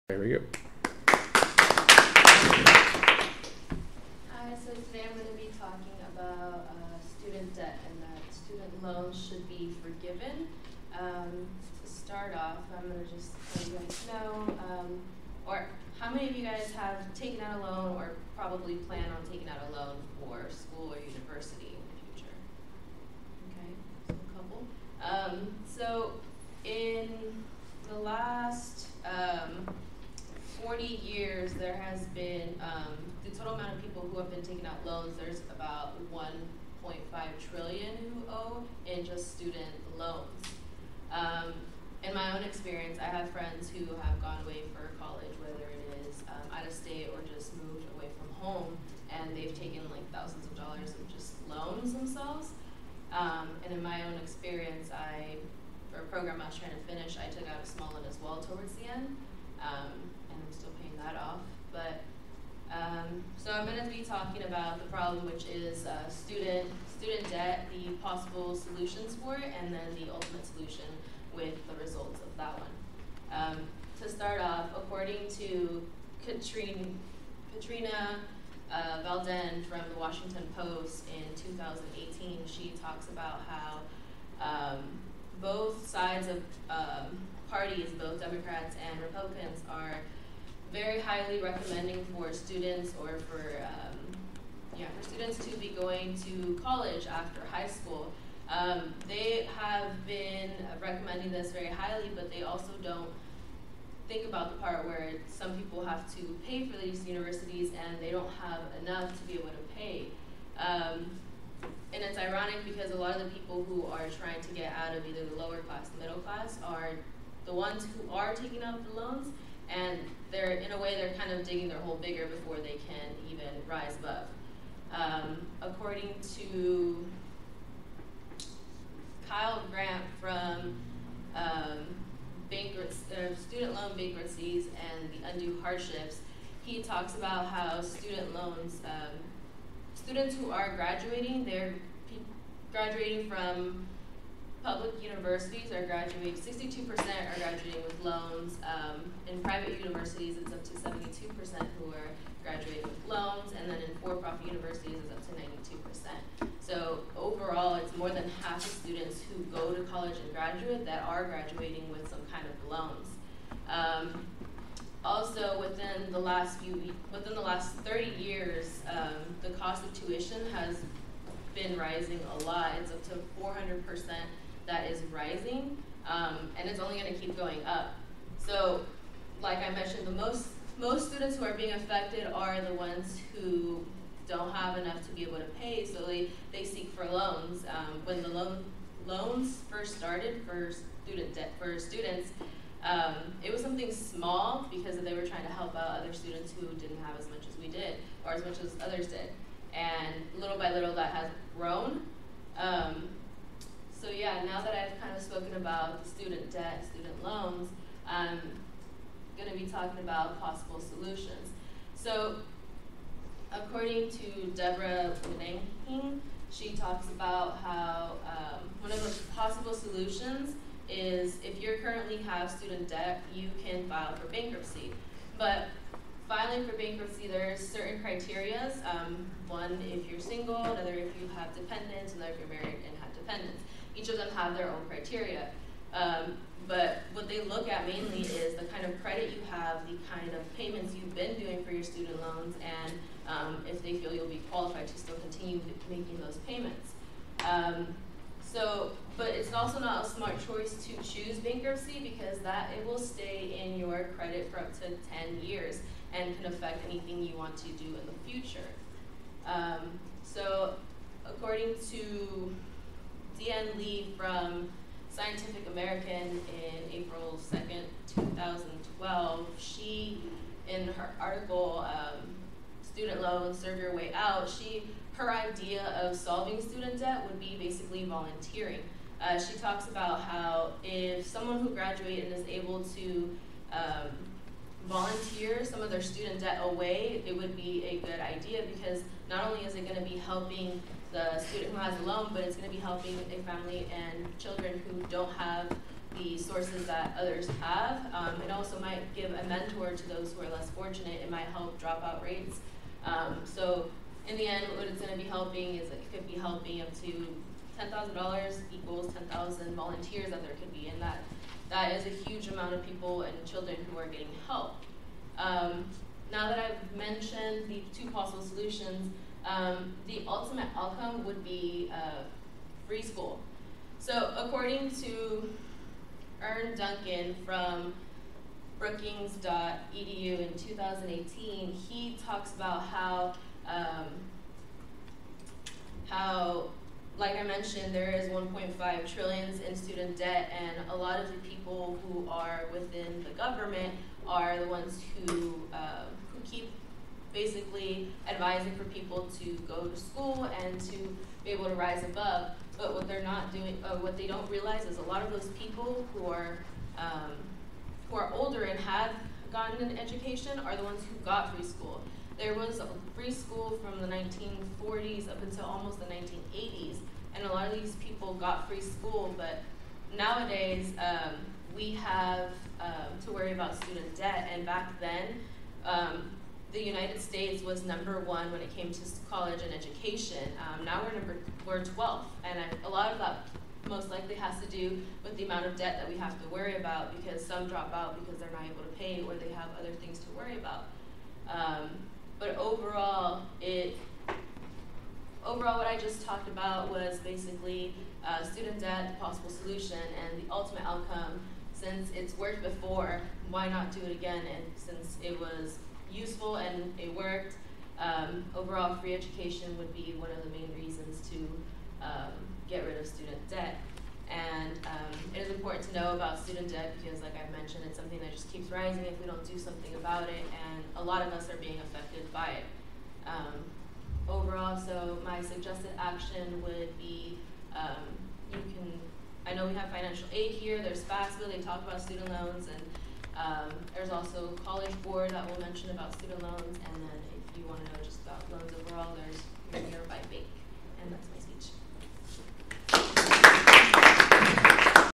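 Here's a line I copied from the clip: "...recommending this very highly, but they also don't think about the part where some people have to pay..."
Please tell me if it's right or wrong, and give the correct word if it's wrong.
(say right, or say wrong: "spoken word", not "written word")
right.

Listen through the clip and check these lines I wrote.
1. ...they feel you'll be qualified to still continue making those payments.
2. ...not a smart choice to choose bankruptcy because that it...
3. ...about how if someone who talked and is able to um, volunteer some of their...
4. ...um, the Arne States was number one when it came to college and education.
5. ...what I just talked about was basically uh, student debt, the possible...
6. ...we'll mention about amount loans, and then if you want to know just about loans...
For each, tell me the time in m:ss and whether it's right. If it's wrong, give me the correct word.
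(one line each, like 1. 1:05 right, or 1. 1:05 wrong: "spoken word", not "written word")
1. 4:03 right
2. 4:09 right
3. 4:39 wrong: "graduated", not "talked"
4. 6:15 wrong: "United", not "Arne"
5. 6:35 right
6. 7:15 wrong: "student", not "amount".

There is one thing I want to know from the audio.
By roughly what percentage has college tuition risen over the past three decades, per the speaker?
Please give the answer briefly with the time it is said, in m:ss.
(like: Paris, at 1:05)
400 percent, at 2:53.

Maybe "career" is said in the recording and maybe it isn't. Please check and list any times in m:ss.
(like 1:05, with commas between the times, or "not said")
not said.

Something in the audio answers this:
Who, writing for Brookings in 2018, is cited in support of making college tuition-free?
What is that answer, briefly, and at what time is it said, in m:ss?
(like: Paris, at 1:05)
Arne Duncan, at 5:26.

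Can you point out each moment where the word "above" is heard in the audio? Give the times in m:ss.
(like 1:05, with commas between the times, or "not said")
2:03, 5:52.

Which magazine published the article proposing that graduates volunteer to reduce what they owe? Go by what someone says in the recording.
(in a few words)
Scientific American.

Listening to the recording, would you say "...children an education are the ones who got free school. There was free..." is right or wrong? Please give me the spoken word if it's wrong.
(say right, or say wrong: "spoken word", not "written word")
wrong: "gotten", not "children".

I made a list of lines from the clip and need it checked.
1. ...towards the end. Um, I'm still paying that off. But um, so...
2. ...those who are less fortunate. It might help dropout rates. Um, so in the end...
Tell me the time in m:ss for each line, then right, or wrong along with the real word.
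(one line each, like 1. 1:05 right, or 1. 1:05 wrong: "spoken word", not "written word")
1. 0:58 right
2. 5:00 right.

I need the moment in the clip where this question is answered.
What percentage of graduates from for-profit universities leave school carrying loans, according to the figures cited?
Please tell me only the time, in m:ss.
2:36.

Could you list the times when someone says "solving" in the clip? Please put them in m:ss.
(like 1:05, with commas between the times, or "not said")
4:36.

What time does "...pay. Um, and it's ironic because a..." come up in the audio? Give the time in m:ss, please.
1:49.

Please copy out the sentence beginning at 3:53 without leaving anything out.
Each of them have their own criteria.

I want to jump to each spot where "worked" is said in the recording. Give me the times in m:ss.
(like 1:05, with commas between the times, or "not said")
6:42, 6:47.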